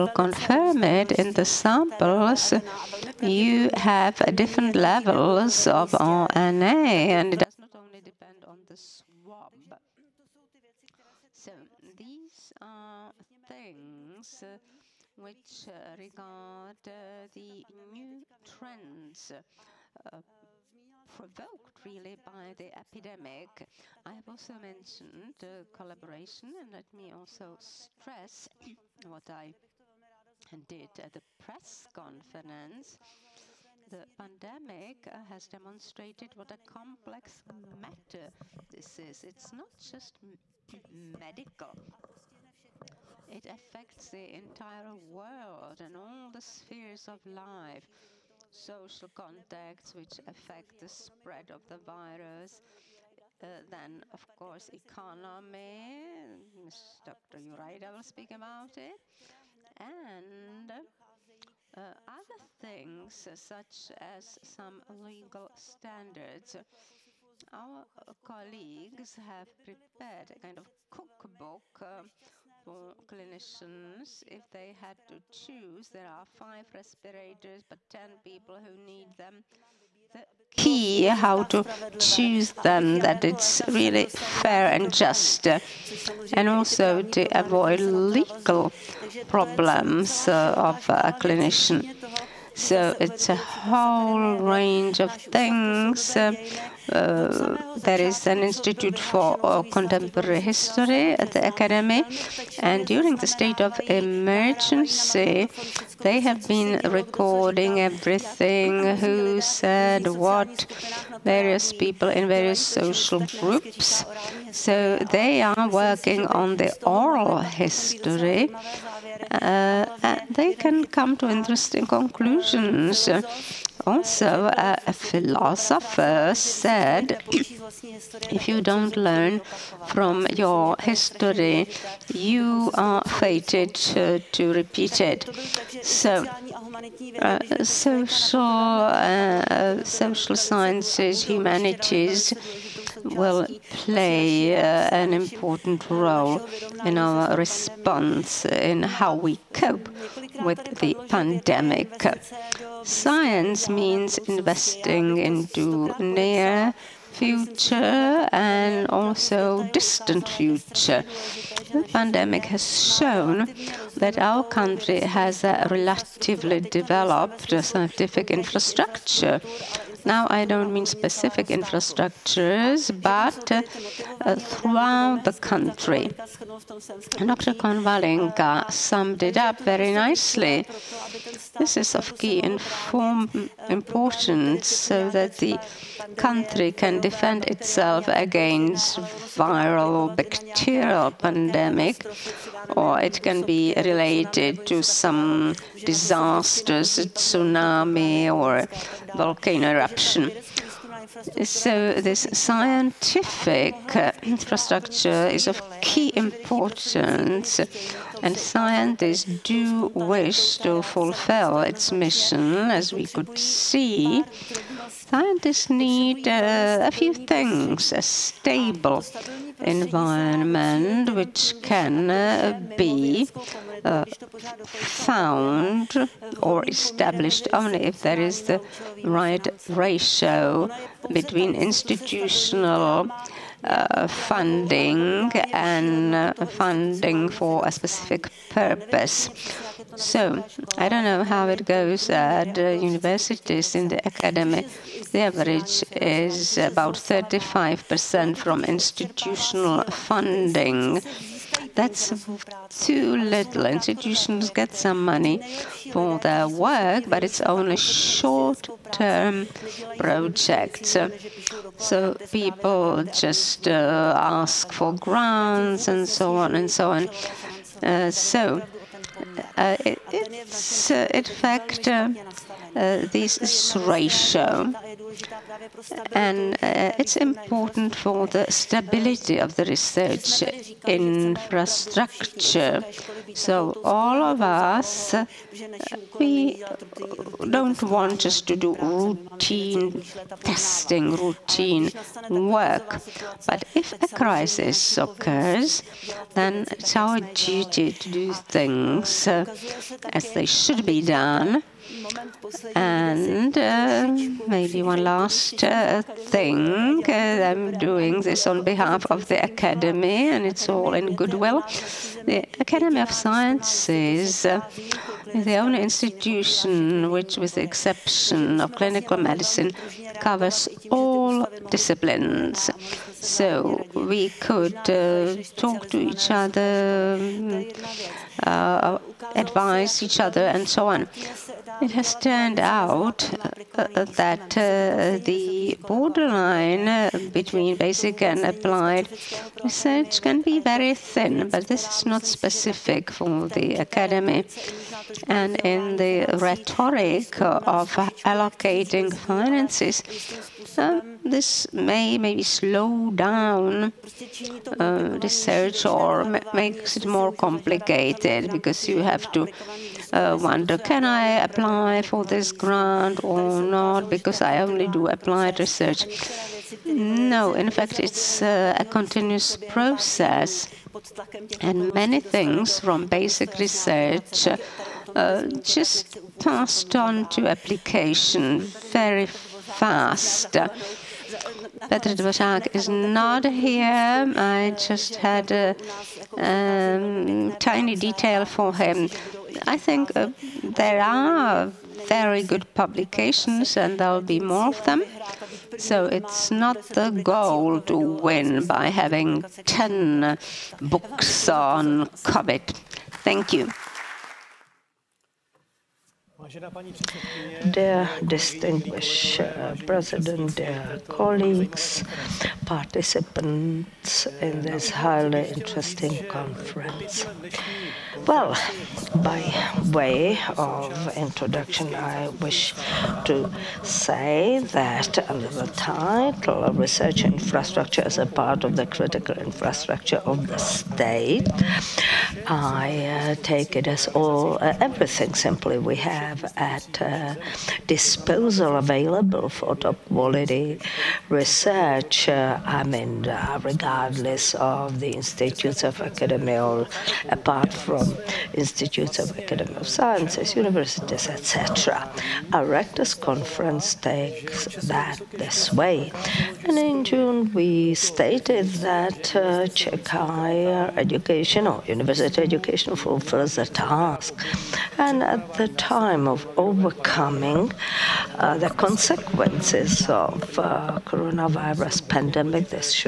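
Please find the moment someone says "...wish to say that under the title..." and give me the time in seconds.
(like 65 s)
422 s.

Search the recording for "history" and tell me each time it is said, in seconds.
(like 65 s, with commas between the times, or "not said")
100 s, 117 s, 130 s.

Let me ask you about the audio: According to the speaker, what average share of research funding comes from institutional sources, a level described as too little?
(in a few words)
35%.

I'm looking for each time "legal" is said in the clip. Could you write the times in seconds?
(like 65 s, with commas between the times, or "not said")
64 s, 87 s.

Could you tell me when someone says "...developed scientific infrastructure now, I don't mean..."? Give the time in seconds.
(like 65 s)
166 s.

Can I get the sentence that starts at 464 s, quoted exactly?
And at the time of overcoming uh, the consequences of uh, coronavirus pandemic.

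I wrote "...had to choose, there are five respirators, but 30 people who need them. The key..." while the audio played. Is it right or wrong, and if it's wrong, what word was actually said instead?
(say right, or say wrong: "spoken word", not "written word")
wrong: "10", not "30".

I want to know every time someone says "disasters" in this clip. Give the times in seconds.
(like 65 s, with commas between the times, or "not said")
195 s.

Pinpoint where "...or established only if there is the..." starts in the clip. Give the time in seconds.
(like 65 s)
226 s.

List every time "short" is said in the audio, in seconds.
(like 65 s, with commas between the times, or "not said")
257 s.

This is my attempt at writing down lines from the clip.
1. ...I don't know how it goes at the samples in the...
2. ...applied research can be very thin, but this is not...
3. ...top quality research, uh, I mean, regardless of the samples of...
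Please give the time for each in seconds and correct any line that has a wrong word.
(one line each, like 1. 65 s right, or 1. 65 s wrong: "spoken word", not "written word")
1. 240 s wrong: "universities", not "samples"
2. 338 s right
3. 439 s wrong: "institutes", not "samples".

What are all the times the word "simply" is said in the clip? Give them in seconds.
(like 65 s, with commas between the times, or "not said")
435 s.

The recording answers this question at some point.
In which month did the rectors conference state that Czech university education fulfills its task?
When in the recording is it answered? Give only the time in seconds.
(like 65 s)
457 s.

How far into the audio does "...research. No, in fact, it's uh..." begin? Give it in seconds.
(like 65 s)
365 s.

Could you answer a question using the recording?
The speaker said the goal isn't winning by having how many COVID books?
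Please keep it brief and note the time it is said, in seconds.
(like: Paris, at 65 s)
10, at 399 s.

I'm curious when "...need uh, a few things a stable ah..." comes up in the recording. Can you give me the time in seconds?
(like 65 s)
215 s.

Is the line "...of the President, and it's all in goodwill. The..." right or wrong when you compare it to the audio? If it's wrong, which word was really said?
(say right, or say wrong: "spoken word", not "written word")
wrong: "Academy", not "President".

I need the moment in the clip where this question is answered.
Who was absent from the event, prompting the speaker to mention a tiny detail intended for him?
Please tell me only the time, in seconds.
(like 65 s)
381 s.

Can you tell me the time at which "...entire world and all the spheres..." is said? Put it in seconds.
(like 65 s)
44 s.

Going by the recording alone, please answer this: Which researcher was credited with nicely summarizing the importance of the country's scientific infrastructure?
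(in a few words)
Dr. Konvalinka.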